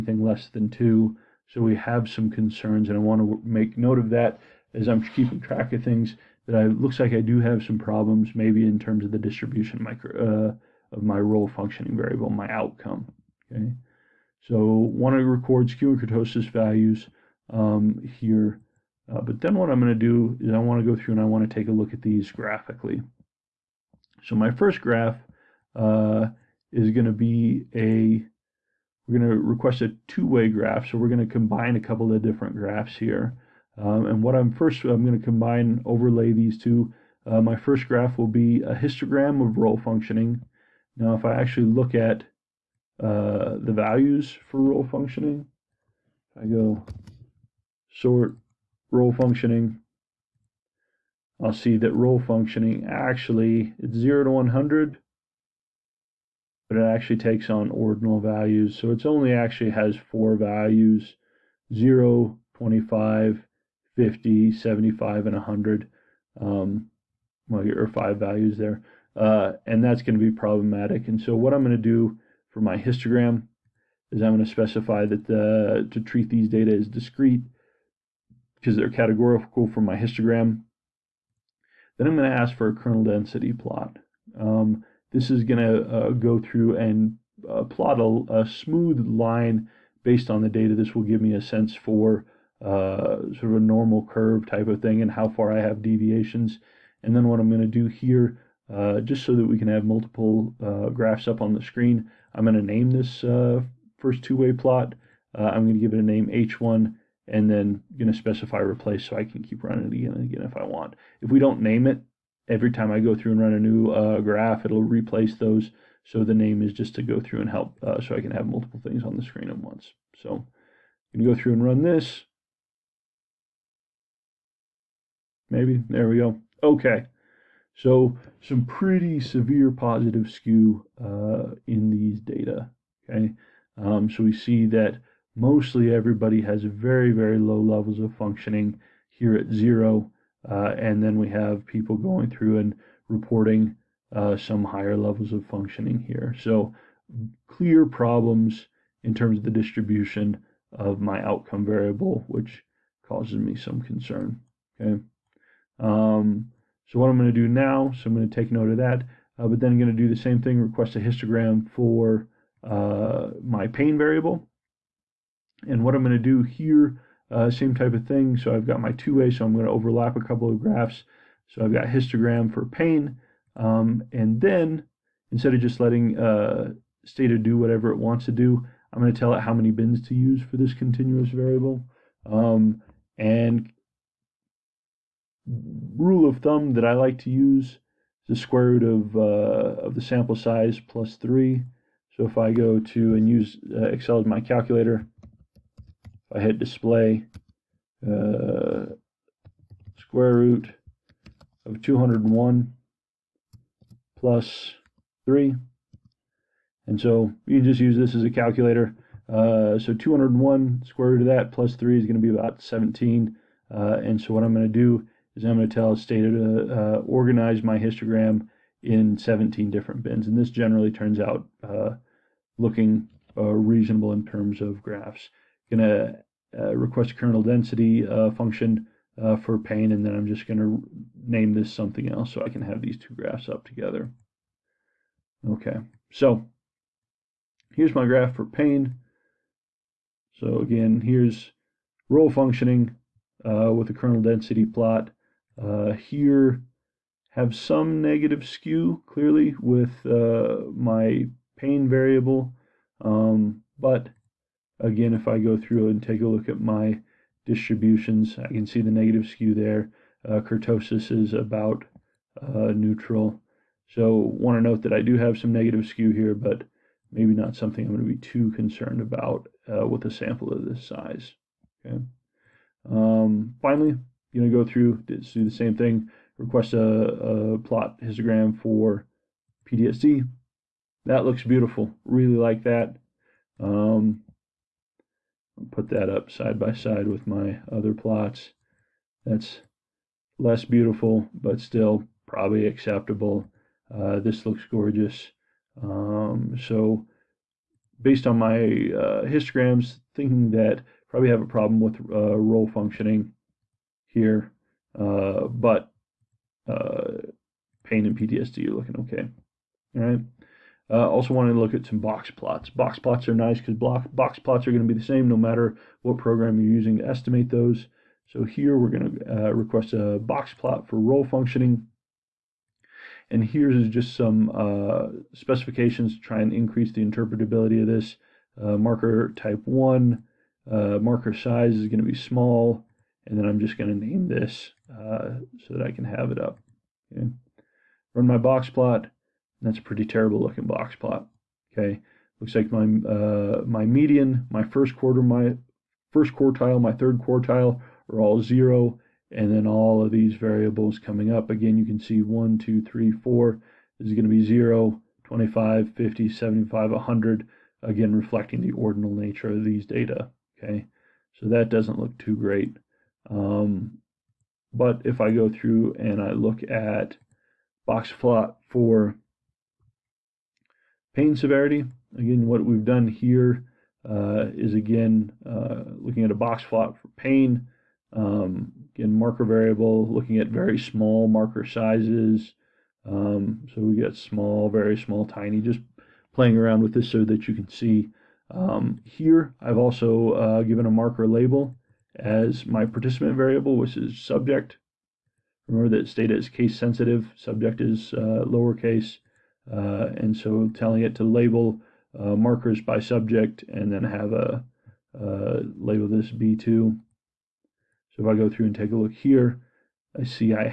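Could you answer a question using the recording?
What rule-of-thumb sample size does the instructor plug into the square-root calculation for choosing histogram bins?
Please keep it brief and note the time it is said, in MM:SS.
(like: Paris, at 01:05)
201, at 03:19.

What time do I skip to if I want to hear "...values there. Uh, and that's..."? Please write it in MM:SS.
01:08.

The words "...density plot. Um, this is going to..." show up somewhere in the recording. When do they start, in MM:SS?
01:23.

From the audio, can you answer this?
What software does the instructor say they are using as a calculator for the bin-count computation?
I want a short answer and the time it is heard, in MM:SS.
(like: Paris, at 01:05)
Excel, at 03:13.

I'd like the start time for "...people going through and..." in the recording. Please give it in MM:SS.
02:21.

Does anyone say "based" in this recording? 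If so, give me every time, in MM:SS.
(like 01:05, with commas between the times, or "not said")
01:30, 04:58.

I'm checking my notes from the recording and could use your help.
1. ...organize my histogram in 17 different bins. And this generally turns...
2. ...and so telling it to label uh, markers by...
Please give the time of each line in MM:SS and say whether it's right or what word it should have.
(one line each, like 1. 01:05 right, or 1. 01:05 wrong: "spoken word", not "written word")
1. 03:37 right
2. 06:40 right.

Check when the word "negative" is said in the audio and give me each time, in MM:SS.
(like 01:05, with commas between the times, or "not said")
04:08, 04:18, 04:25.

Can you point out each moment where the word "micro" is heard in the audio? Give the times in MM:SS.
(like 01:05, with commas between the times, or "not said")
00:09.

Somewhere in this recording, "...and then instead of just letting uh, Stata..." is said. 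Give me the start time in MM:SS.
02:54.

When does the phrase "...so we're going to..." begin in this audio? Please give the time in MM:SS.
00:30.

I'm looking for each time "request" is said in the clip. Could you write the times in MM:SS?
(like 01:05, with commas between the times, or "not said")
00:29, 02:40, 03:46, 04:36, 05:19.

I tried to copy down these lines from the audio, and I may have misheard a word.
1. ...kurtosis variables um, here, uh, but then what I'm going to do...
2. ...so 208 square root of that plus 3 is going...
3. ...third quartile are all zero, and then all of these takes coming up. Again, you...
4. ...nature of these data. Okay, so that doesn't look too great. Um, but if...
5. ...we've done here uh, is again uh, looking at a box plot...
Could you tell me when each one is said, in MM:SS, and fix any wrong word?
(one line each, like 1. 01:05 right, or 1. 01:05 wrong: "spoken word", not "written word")
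1. 00:15 wrong: "values", not "variables"
2. 03:29 wrong: "201", not "208"
3. 05:46 wrong: "variables", not "takes"
4. 05:59 right
5. 06:12 right.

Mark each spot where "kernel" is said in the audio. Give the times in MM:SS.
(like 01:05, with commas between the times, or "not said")
01:22, 03:47, 04:03.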